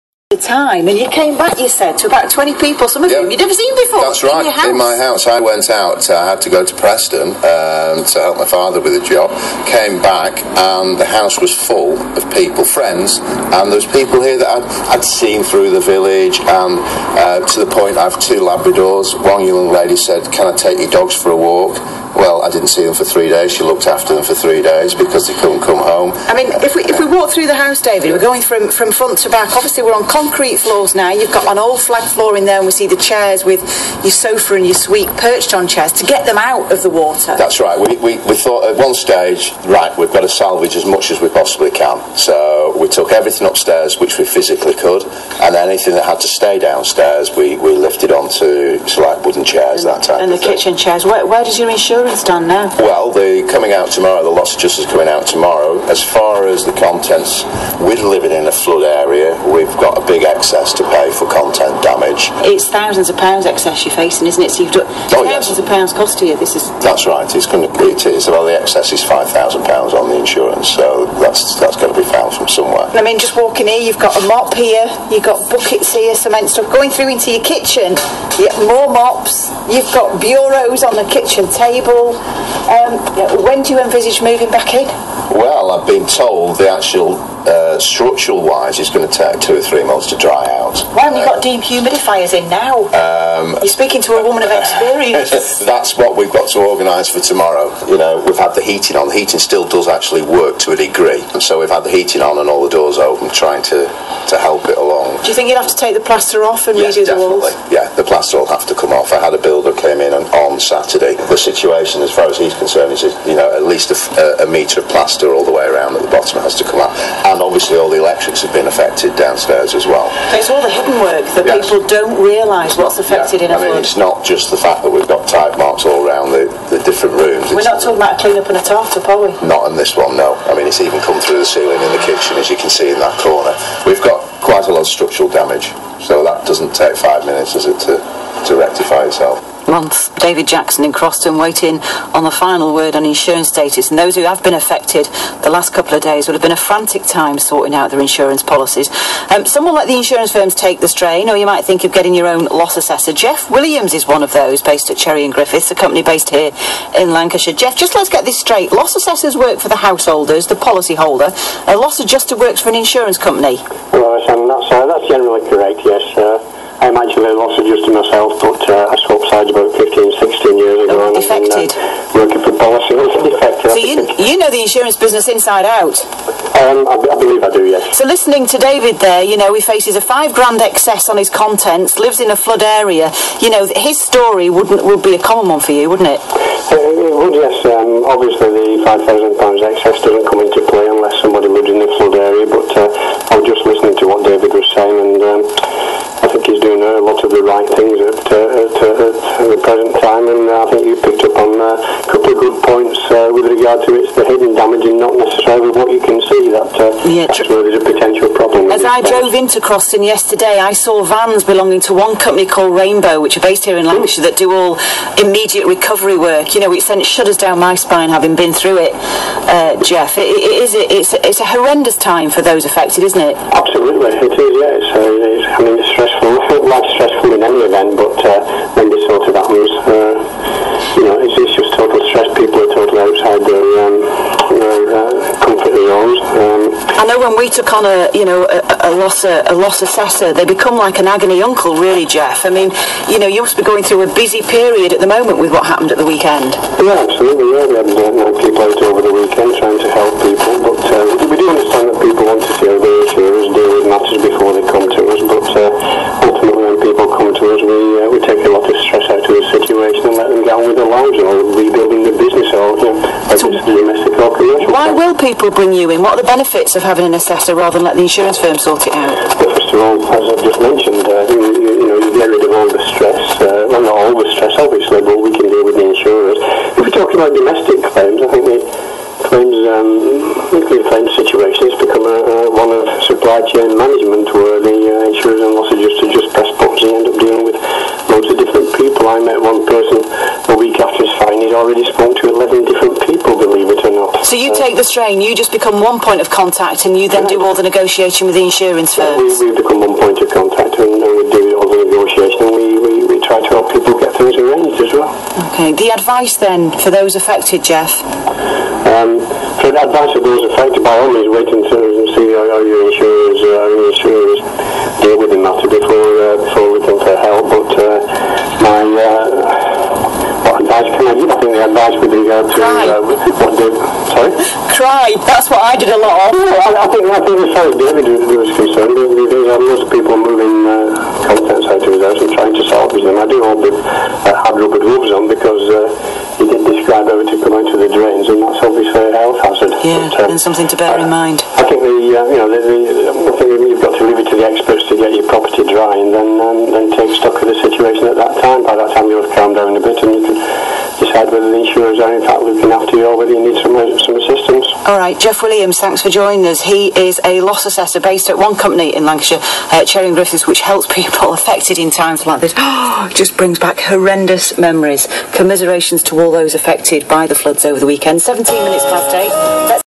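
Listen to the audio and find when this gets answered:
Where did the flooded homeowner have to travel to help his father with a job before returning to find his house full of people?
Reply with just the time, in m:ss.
0:06.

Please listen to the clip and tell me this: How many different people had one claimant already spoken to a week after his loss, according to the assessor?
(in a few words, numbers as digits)
11.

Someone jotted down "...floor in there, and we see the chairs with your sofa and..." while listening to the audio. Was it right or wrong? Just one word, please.
right.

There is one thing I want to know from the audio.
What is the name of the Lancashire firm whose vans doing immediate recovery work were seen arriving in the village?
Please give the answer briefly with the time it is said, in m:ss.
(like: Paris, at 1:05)
Rainbow, at 3:32.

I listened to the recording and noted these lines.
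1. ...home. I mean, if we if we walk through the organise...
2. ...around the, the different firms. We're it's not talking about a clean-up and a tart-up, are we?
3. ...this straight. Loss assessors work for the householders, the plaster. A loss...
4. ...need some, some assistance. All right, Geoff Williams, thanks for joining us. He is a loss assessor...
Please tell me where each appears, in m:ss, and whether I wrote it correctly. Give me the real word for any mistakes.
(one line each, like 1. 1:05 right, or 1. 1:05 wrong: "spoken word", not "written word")
1. 0:25 wrong: "house", not "organise"
2. 2:06 wrong: "rooms", not "firms"
3. 2:38 wrong: "policyholder", not "plaster"
4. 5:53 right.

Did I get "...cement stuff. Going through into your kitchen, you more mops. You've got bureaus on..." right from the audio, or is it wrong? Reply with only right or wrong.
right.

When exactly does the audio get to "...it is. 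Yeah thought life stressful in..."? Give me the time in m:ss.
3:44.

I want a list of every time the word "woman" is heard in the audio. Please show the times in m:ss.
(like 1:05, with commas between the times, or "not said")
1:34.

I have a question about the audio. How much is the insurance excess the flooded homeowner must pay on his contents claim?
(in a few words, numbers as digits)
£5,000.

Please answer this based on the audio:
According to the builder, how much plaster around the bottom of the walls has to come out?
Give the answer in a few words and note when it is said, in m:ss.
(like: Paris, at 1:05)
a metre, at 1:54.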